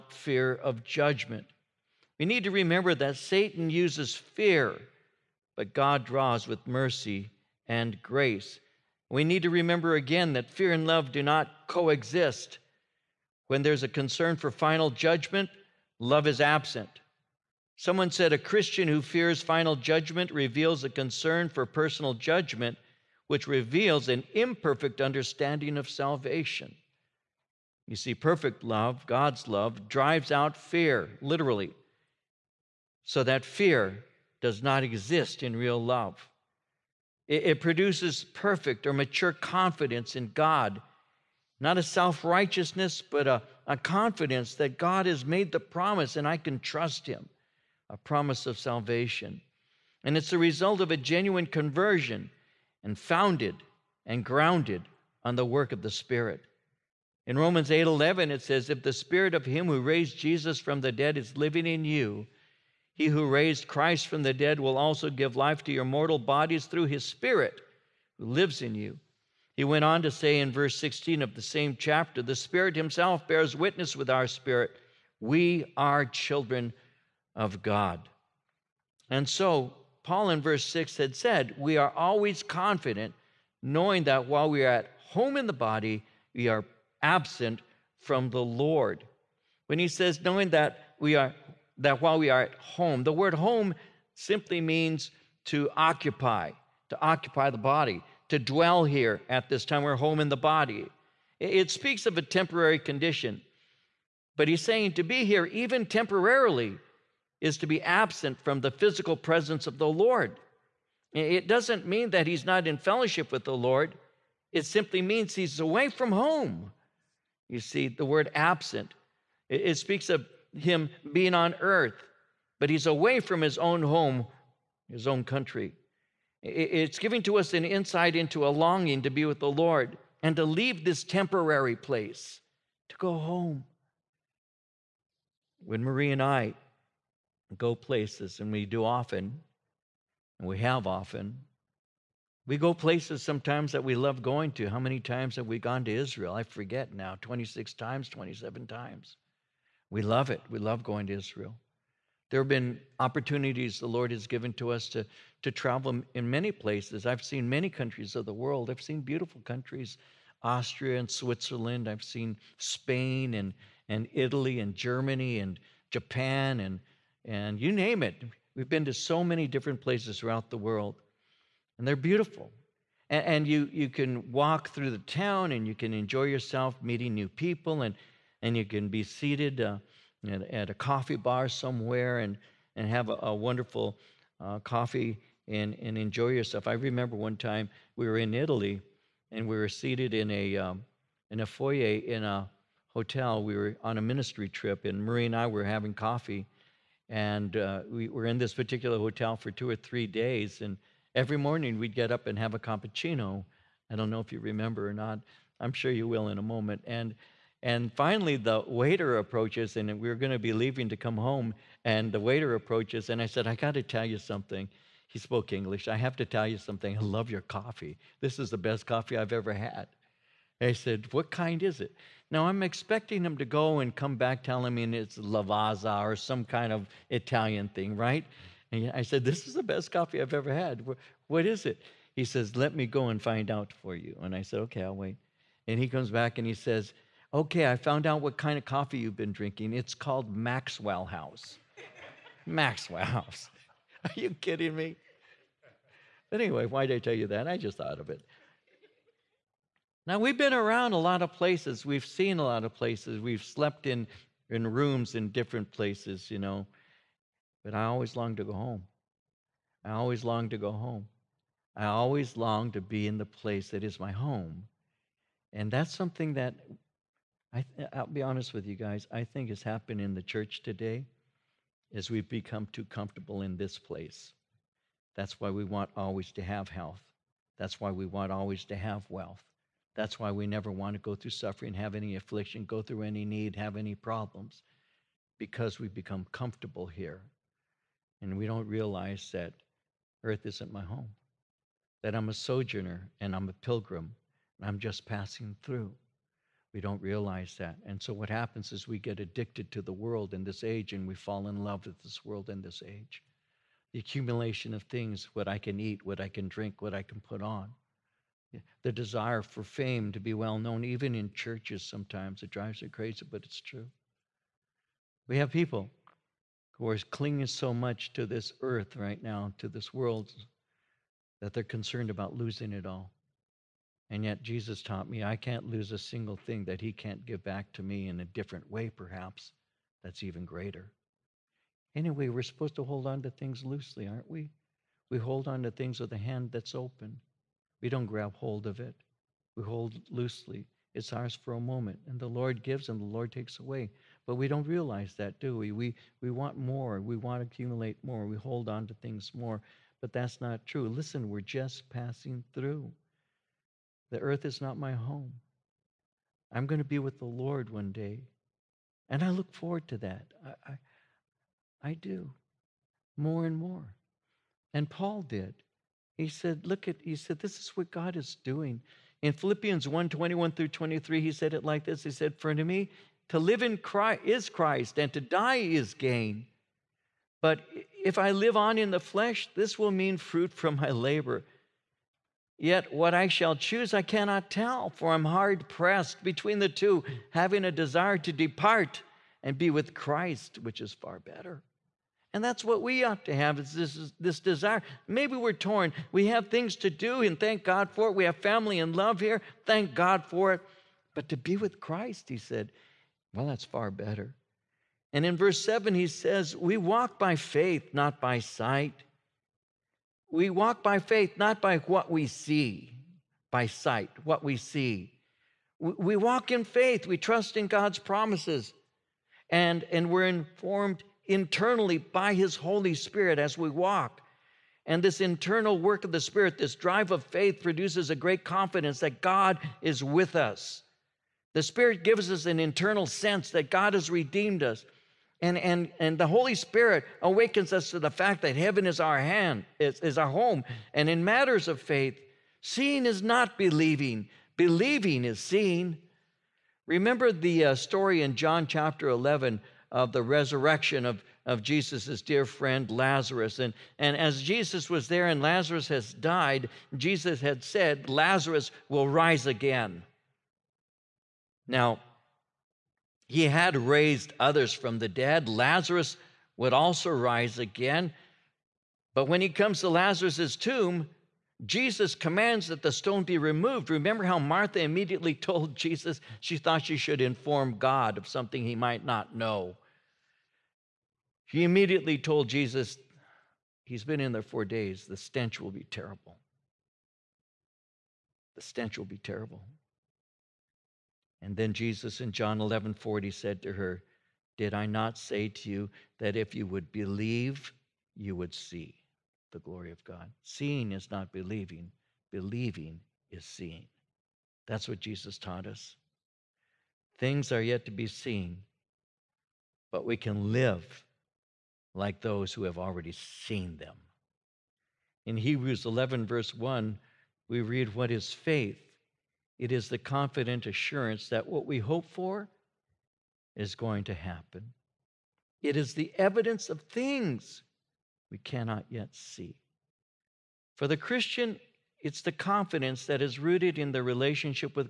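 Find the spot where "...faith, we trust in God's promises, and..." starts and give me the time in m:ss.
6:56.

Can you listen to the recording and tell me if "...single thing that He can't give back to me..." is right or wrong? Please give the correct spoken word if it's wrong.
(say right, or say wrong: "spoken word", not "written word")
right.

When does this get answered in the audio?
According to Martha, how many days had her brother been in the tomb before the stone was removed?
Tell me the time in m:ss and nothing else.
8:04.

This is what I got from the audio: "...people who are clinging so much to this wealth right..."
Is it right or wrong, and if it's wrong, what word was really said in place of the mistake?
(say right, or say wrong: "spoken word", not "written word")
wrong: "earth", not "wealth".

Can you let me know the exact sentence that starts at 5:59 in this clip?
And I look forward to that.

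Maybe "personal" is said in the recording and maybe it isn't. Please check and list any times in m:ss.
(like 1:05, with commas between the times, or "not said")
0:21.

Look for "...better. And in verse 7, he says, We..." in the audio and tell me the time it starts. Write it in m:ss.
6:43.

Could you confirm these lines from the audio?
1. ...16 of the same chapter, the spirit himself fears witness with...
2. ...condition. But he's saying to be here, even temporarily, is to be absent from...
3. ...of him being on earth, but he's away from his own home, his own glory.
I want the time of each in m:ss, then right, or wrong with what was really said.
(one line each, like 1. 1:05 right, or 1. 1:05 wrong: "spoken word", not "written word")
1. 1:10 wrong: "bears", not "fears"
2. 1:42 right
3. 2:00 wrong: "country", not "glory".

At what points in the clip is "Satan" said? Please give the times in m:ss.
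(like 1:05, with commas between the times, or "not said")
0:03.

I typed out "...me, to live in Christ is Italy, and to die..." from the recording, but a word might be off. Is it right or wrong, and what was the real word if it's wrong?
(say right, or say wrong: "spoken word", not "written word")
wrong: "Christ", not "Italy".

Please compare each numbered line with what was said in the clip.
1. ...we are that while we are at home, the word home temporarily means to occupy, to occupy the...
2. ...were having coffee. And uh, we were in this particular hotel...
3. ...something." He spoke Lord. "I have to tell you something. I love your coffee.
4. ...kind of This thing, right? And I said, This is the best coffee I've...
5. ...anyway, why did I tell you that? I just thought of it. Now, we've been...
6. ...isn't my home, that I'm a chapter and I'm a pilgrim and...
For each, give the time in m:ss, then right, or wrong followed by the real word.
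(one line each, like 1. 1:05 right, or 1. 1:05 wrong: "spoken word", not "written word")
1. 1:30 wrong: "simply", not "temporarily"
2. 3:15 right
3. 3:34 wrong: "English", not "Lord"
4. 3:46 wrong: "Italian", not "This"
5. 4:06 right
6. 4:50 wrong: "sojourner", not "chapter".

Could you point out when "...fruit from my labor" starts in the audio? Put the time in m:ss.
6:20.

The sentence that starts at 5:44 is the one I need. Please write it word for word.
But we don't realize that, do we?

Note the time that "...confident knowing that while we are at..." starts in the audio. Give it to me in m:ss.
1:22.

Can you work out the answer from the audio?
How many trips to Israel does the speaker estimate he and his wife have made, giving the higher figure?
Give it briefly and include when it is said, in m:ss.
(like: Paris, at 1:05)
27, at 2:28.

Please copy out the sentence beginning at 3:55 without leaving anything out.
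And he comes back and he says, Okay, I found out what kind of coffee you've been drinking.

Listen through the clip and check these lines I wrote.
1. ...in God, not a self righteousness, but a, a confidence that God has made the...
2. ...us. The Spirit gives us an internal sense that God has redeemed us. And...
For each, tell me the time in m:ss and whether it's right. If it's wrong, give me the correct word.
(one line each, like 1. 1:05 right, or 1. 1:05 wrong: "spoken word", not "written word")
1. 0:40 right
2. 7:10 right.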